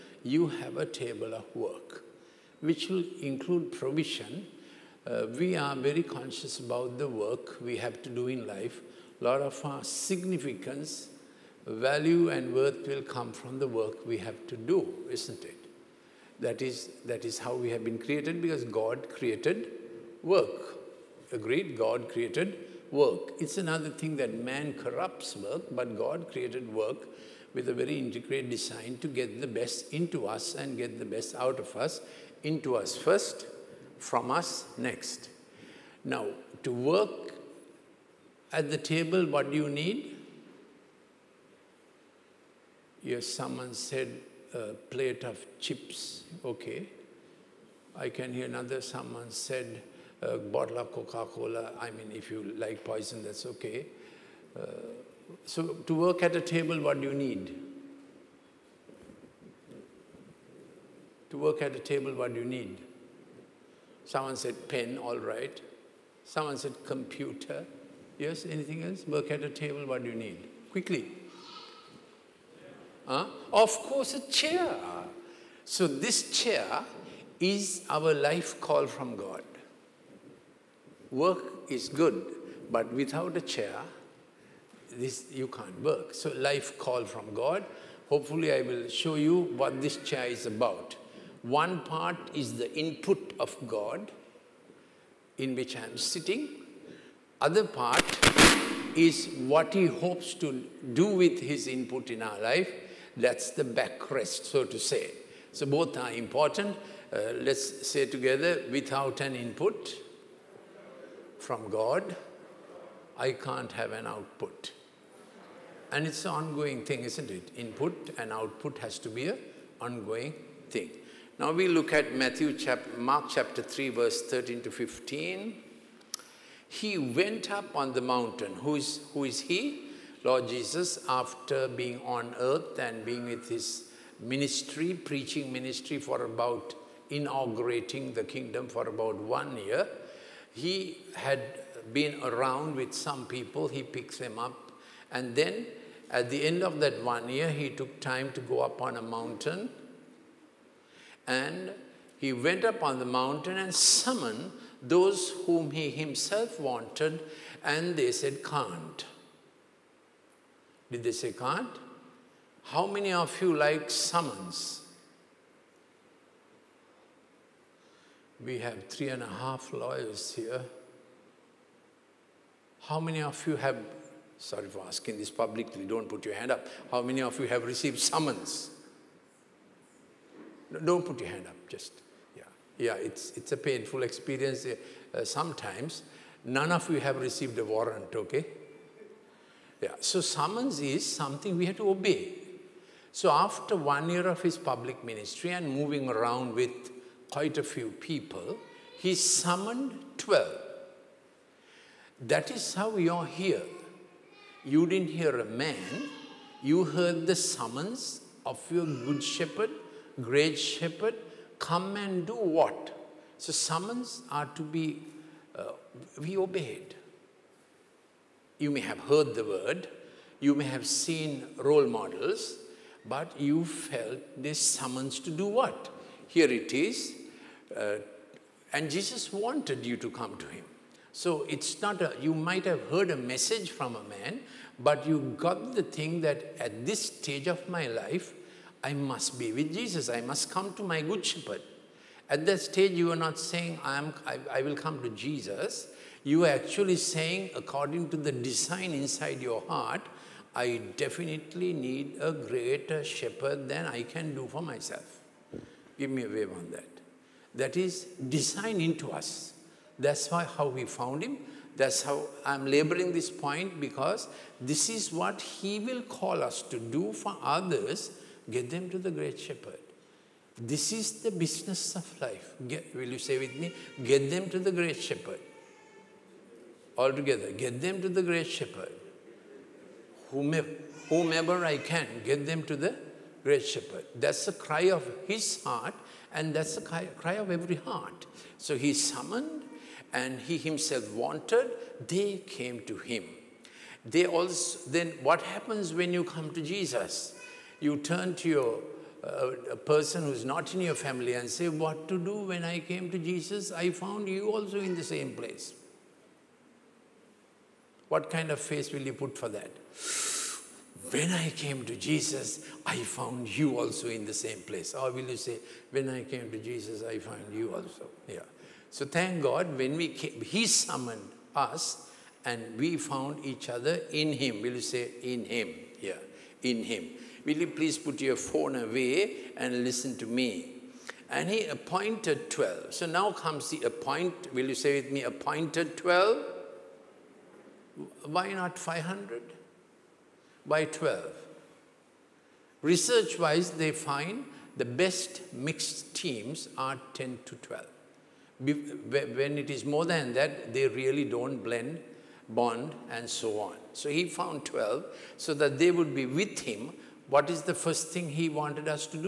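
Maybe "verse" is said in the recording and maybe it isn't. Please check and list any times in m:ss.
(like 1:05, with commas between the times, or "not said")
2:03.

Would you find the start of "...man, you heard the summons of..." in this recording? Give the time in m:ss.
3:25.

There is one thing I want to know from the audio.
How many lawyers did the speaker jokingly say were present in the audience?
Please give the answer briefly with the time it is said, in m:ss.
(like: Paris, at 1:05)
3.5, at 2:48.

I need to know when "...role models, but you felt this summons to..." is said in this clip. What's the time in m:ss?
3:41.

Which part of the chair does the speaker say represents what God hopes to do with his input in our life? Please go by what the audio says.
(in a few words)
The backrest.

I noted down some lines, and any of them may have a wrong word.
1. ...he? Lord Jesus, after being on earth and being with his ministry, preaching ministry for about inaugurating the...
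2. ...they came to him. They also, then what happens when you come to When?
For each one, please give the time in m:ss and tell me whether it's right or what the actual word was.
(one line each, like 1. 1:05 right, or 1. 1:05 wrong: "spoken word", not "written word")
1. 2:09 right
2. 4:52 wrong: "Jesus", not "When".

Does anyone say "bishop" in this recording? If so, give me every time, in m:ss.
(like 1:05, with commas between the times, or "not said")
not said.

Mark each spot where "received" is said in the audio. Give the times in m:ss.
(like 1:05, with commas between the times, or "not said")
2:57, 3:07.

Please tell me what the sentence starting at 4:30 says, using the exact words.
This is the business of life.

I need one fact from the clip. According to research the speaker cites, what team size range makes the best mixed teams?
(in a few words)
10 to 12.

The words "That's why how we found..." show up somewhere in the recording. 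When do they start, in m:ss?
4:19.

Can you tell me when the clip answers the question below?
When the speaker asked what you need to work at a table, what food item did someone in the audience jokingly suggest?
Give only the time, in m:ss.
0:44.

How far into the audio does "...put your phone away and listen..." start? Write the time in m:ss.
5:27.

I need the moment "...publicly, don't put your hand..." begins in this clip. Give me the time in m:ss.
2:55.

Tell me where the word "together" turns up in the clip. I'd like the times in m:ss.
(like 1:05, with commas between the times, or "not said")
1:48, 4:37.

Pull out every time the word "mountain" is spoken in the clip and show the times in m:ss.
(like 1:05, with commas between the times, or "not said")
2:08, 2:29, 2:33.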